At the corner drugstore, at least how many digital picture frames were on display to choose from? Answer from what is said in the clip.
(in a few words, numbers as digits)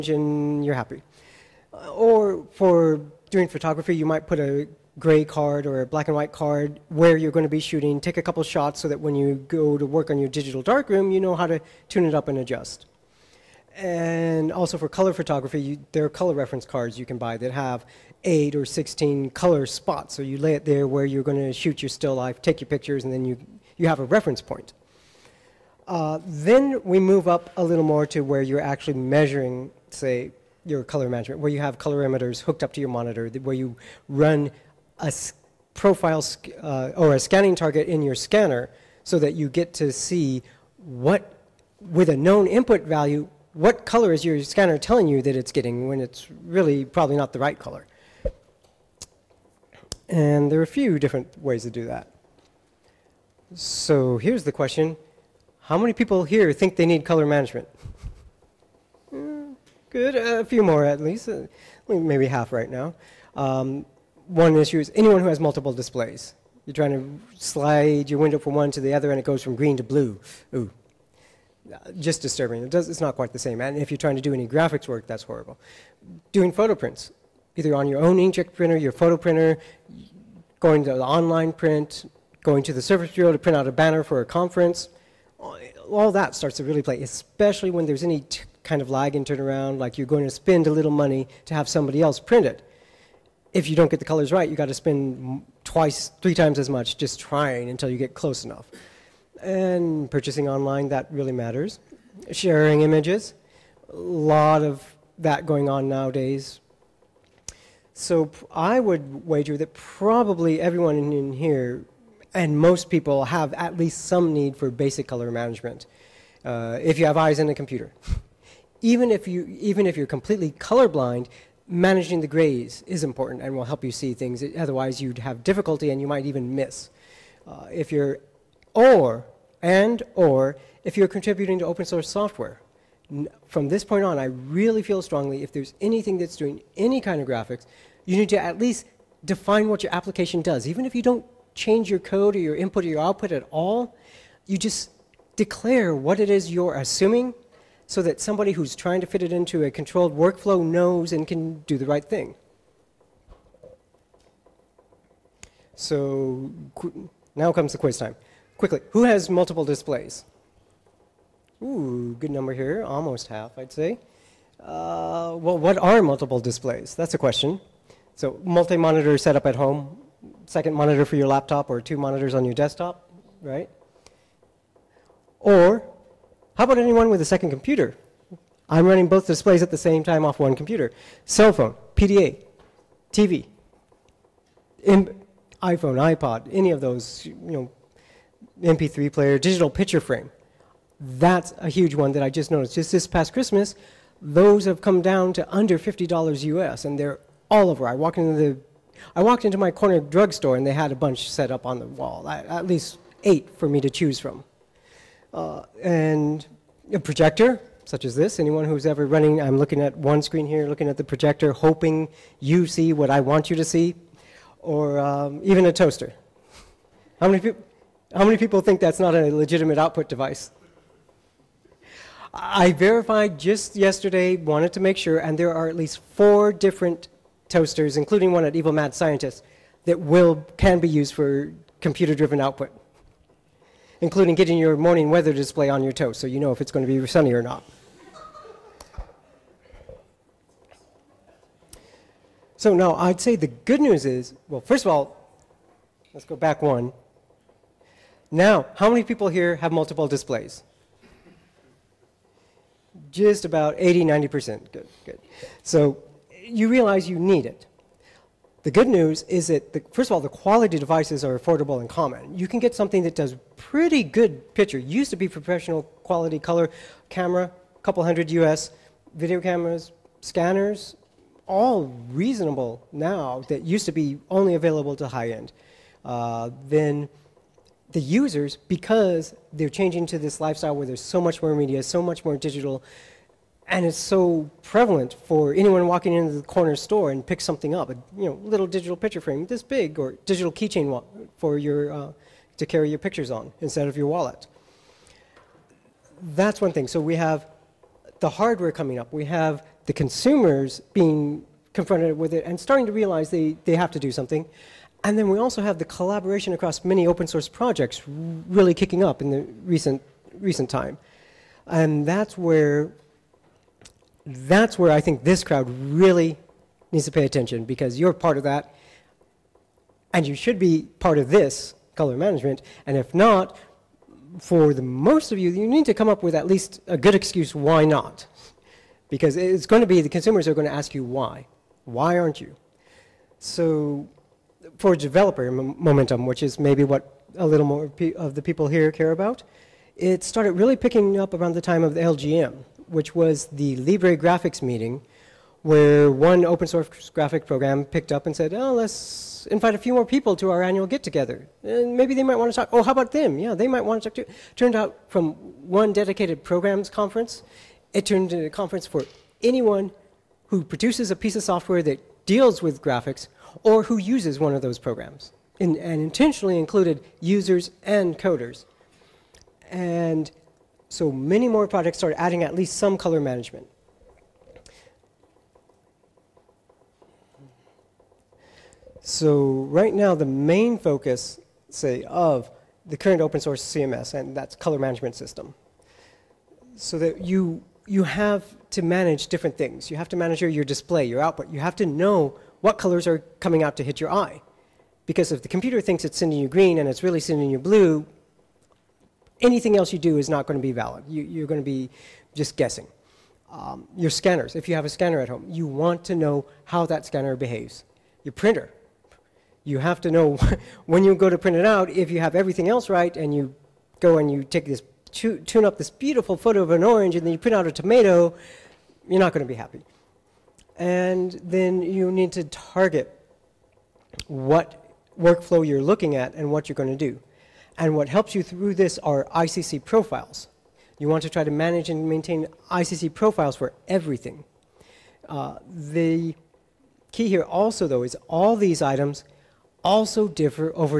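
8.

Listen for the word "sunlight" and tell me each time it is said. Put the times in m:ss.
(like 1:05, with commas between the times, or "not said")
not said.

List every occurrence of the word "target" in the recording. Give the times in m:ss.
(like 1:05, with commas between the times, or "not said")
0:37, 7:02.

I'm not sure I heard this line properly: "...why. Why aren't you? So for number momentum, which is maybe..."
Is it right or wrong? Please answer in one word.
wrong.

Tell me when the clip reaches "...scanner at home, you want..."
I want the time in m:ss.
6:44.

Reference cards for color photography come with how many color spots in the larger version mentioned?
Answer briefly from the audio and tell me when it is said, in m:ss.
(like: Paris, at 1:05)
16, at 0:18.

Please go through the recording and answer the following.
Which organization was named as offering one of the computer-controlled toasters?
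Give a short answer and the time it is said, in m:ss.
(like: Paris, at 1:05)
Evil Mad Scientist, at 3:48.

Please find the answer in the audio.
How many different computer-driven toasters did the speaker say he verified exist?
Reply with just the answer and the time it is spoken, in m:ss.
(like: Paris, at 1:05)
4, at 3:46.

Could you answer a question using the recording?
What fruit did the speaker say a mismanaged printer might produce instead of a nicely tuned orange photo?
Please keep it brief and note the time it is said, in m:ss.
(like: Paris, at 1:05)
a tomato, at 6:57.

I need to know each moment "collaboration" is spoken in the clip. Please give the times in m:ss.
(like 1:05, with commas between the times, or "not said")
5:05.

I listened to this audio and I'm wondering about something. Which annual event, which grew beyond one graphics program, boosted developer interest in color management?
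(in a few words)
Libre Graphics Meeting.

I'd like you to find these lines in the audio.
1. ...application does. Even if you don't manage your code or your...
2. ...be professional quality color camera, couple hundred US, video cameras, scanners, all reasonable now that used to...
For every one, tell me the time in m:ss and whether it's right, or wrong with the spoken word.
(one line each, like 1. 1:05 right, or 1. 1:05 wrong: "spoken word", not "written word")
1. 2:19 wrong: "change", not "manage"
2. 4:25 right.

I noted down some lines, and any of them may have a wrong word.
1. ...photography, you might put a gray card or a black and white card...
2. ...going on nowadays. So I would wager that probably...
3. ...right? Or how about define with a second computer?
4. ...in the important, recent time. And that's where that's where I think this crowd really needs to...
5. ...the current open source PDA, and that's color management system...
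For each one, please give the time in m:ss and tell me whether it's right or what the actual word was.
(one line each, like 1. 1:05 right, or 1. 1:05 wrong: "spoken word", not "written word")
1. 0:03 right
2. 1:45 right
3. 2:53 wrong: "anyone", not "define"
4. 5:09 wrong: "recent", not "important"
5. 6:22 wrong: "CMS", not "PDA".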